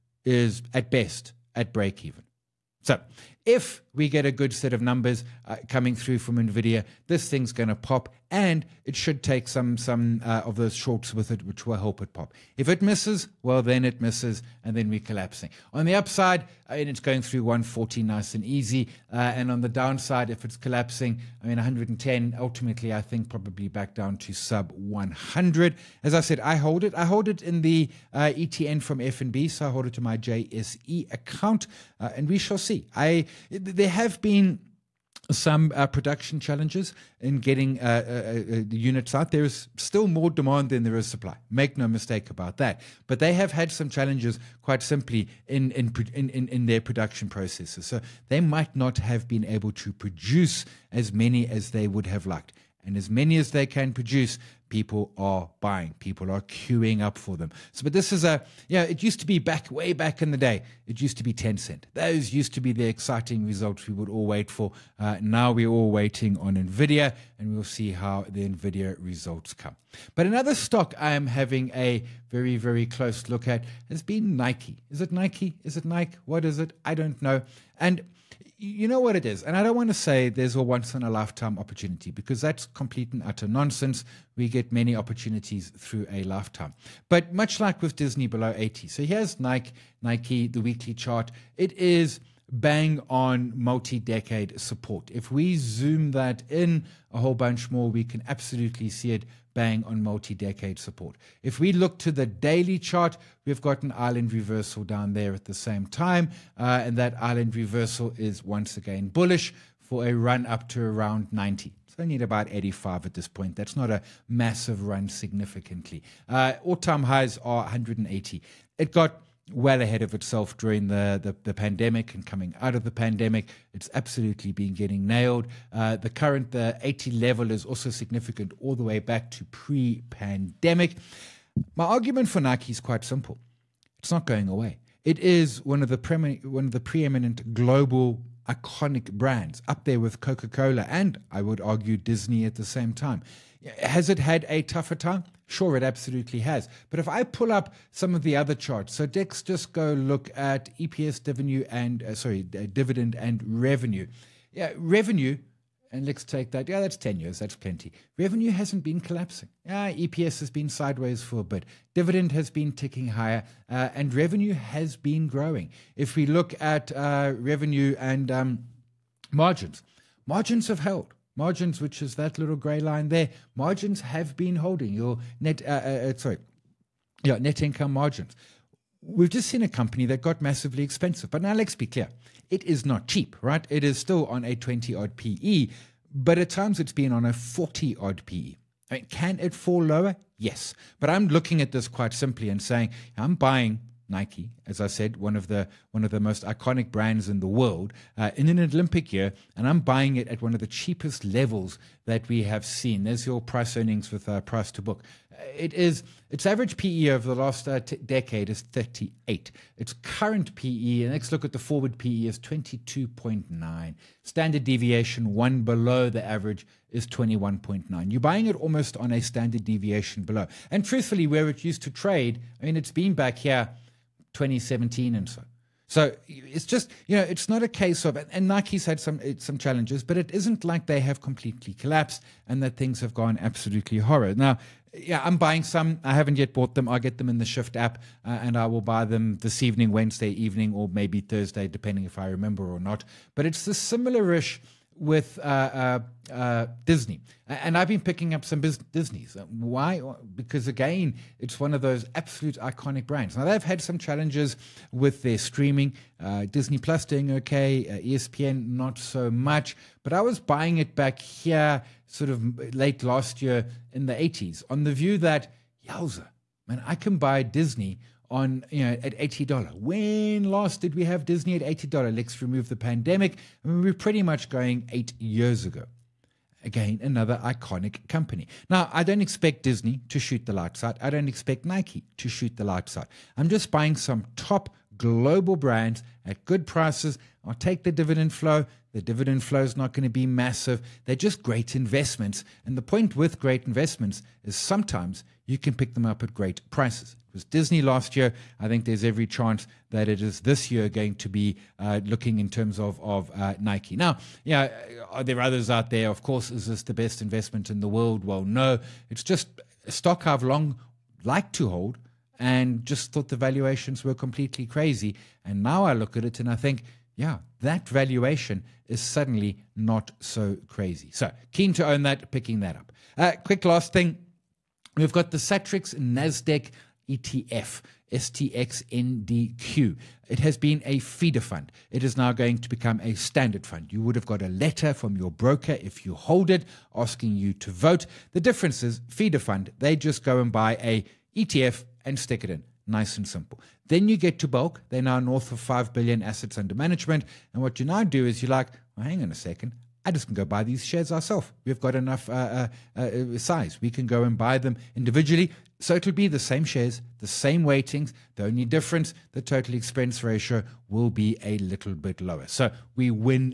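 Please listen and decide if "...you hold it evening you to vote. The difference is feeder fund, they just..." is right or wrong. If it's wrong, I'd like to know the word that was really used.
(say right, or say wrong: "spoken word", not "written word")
wrong: "asking", not "evening".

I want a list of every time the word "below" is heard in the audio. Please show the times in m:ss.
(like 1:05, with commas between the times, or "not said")
1:28, 3:35, 3:40.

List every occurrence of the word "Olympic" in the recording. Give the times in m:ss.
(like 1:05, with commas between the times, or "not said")
3:18.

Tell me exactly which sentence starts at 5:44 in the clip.
They're now north of 5 billion assets under management.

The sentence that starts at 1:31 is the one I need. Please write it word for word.
It is bang on multi decade support.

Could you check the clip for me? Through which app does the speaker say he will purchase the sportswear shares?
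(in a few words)
Shyft.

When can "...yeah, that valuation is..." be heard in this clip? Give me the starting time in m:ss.
5:17.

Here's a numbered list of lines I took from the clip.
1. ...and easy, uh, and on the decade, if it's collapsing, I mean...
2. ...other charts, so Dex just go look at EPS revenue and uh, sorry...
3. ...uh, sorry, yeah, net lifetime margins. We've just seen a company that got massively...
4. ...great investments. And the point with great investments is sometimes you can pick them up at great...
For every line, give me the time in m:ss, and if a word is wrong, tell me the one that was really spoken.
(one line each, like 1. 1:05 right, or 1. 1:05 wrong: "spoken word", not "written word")
1. 0:18 wrong: "downside", not "decade"
2. 2:28 right
3. 2:56 wrong: "income", not "lifetime"
4. 4:51 right.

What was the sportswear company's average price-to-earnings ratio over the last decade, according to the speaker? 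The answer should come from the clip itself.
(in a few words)
38.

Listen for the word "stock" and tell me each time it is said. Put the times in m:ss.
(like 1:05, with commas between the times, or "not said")
1:10, 5:09.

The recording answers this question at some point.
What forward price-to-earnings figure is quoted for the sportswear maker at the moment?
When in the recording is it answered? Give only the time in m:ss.
3:32.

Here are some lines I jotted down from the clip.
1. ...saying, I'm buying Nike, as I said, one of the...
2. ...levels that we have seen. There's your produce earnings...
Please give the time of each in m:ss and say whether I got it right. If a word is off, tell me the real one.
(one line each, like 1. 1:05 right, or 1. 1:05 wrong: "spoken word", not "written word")
1. 3:12 right
2. 3:21 wrong: "price", not "produce".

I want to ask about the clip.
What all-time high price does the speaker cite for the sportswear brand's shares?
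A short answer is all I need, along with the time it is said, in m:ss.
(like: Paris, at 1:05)
180, at 1:57.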